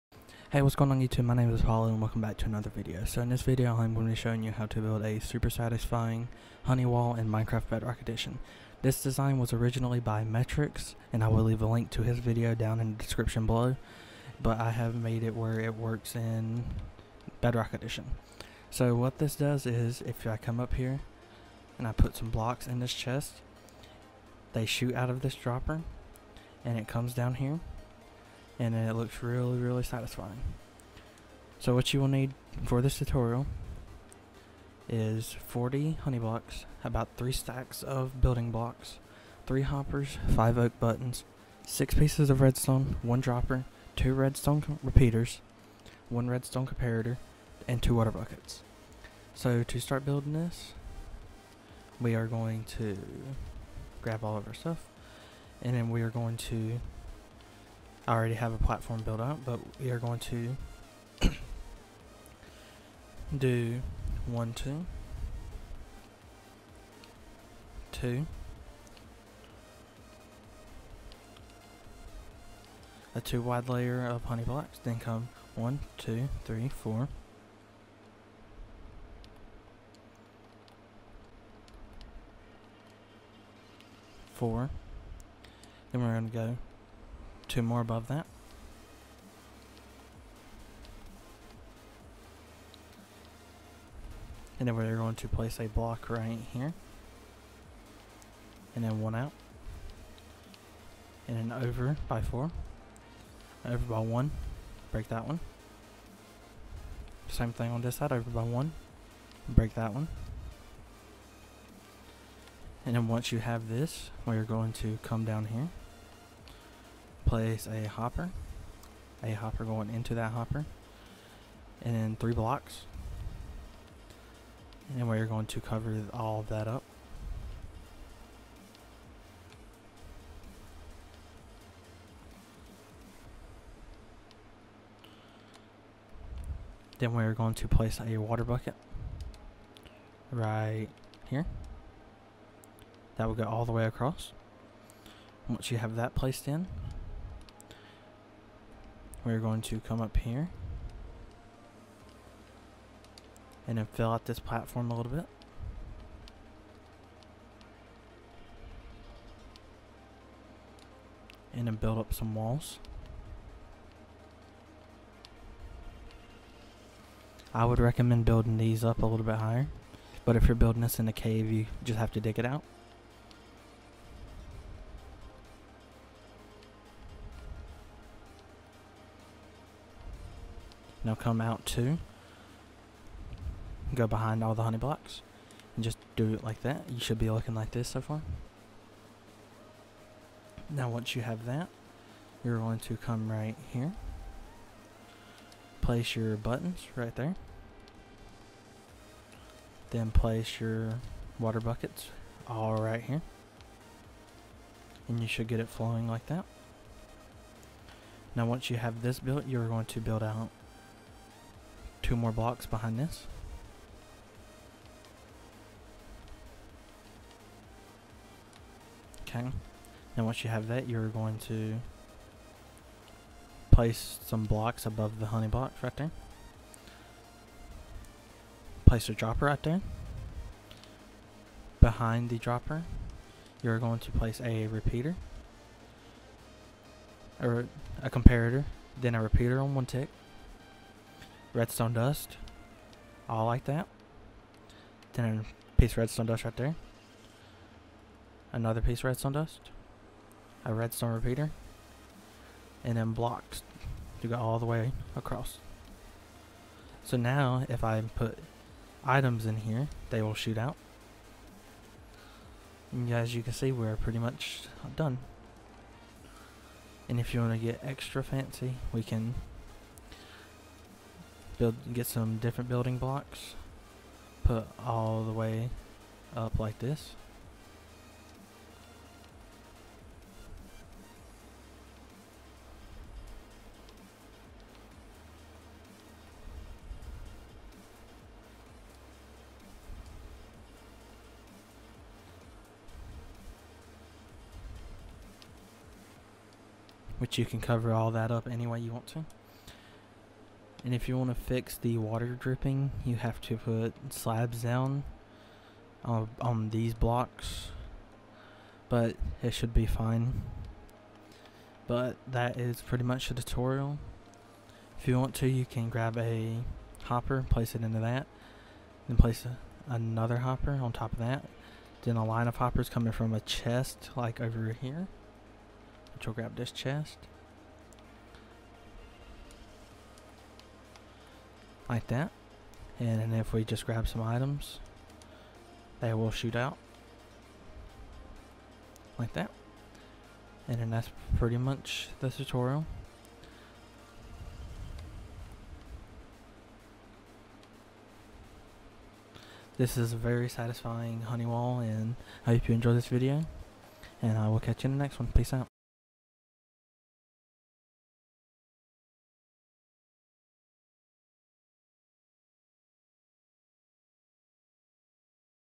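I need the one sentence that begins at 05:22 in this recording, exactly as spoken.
Then a line of hoppers coming from a chest like over here, which will grab this chest.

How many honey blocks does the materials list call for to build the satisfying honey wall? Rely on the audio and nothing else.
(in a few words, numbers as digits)
40.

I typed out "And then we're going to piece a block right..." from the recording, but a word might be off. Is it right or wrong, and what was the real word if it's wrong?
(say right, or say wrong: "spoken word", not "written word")
wrong: "place", not "piece".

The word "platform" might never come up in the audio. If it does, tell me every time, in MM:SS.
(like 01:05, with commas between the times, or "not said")
00:58, 02:34.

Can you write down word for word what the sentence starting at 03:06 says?
You should be looking like this so far.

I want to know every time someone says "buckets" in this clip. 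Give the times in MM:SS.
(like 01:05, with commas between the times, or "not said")
00:48, 02:18, 03:21.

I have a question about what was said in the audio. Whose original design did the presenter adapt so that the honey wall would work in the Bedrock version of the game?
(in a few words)
Metrics.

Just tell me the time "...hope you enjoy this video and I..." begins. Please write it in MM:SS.
05:52.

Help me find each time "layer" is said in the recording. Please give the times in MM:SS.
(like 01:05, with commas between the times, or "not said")
01:13.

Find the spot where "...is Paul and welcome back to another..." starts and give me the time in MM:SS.
00:01.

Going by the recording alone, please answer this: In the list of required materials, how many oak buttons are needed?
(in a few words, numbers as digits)
5.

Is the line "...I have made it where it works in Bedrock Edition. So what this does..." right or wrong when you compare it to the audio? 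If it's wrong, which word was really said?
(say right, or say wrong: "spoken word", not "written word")
right.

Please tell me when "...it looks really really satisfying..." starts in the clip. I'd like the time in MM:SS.
00:28.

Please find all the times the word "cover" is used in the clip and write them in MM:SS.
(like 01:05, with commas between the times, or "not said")
02:05, 04:57.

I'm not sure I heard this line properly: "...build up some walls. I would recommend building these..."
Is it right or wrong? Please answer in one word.
right.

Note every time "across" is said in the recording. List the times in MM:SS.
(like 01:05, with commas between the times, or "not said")
02:23, 04:15.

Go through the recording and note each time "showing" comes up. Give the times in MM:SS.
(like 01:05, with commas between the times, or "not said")
00:04.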